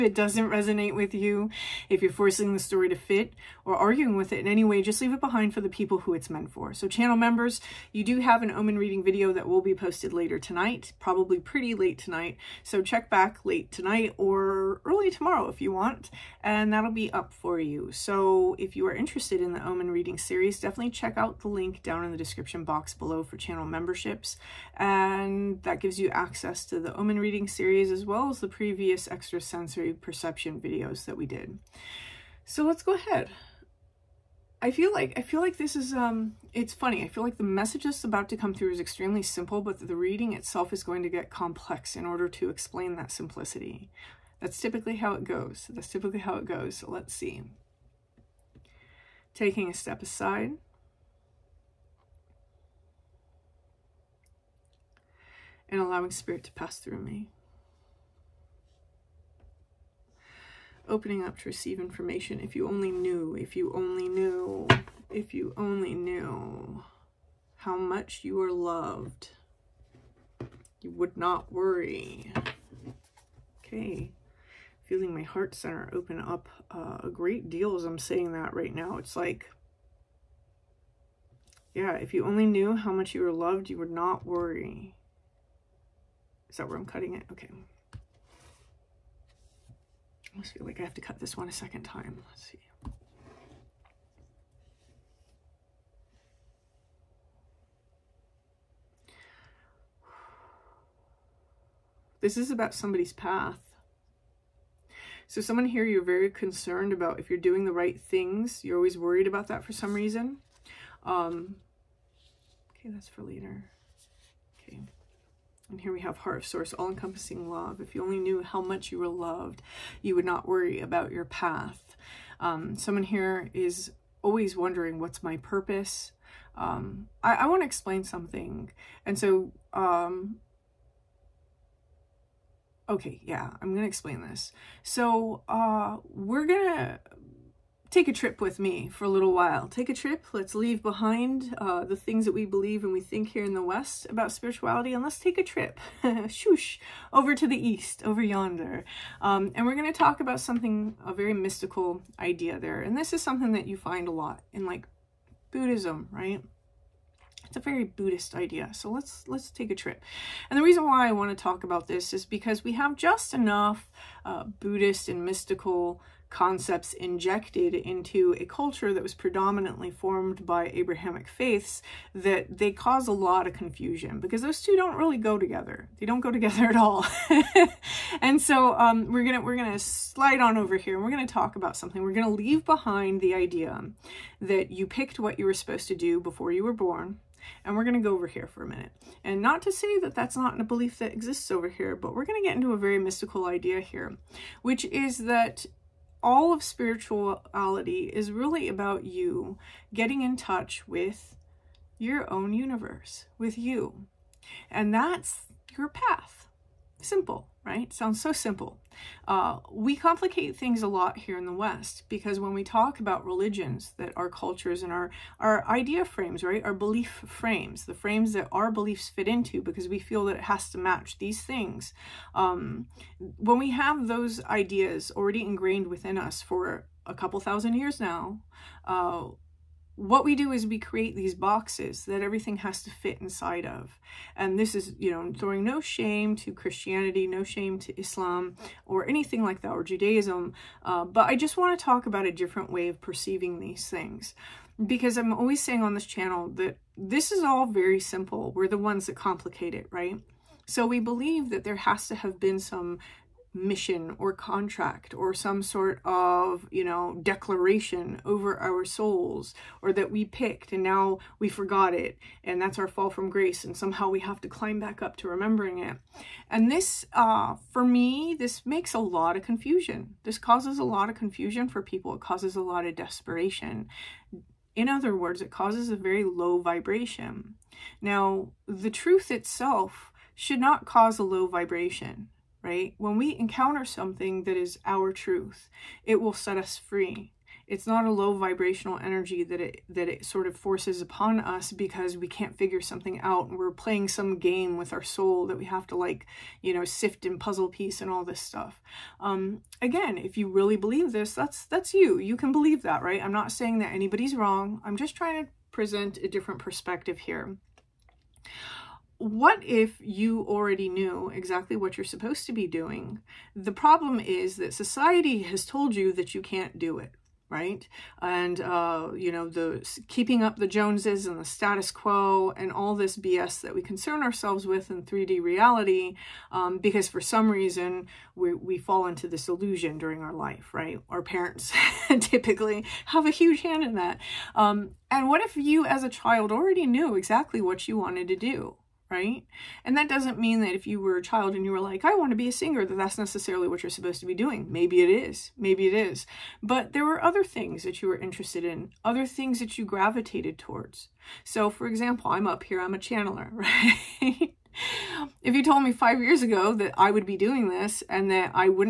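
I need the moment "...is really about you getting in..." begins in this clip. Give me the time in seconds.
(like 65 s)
198 s.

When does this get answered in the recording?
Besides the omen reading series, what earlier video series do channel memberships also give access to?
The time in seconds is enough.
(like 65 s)
29 s.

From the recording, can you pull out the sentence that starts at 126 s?
Um, I, I want to explain something.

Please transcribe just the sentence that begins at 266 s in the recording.
And this, uh, for me, this makes a lot of confusion.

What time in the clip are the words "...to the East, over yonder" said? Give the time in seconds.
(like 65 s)
147 s.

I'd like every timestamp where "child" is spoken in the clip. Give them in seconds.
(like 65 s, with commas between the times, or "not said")
336 s, 341 s.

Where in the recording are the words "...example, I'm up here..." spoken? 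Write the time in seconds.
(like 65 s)
351 s.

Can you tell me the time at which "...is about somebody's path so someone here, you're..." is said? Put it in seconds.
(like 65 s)
102 s.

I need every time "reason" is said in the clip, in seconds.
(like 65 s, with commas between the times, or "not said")
109 s, 160 s, 327 s.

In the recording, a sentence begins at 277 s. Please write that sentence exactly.
Now, the truth itself should not cause a low vibration right?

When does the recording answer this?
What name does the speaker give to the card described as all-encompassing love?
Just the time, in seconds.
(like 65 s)
116 s.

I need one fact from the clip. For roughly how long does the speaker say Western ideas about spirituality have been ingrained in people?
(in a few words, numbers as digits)
A couple thousand years.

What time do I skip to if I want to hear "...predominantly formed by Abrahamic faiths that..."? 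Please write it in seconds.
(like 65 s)
169 s.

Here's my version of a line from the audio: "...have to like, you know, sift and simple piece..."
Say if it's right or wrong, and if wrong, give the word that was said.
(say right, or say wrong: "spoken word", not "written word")
wrong: "puzzle", not "simple".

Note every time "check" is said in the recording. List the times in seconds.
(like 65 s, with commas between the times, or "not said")
12 s, 20 s.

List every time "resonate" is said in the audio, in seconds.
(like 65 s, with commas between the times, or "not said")
0 s.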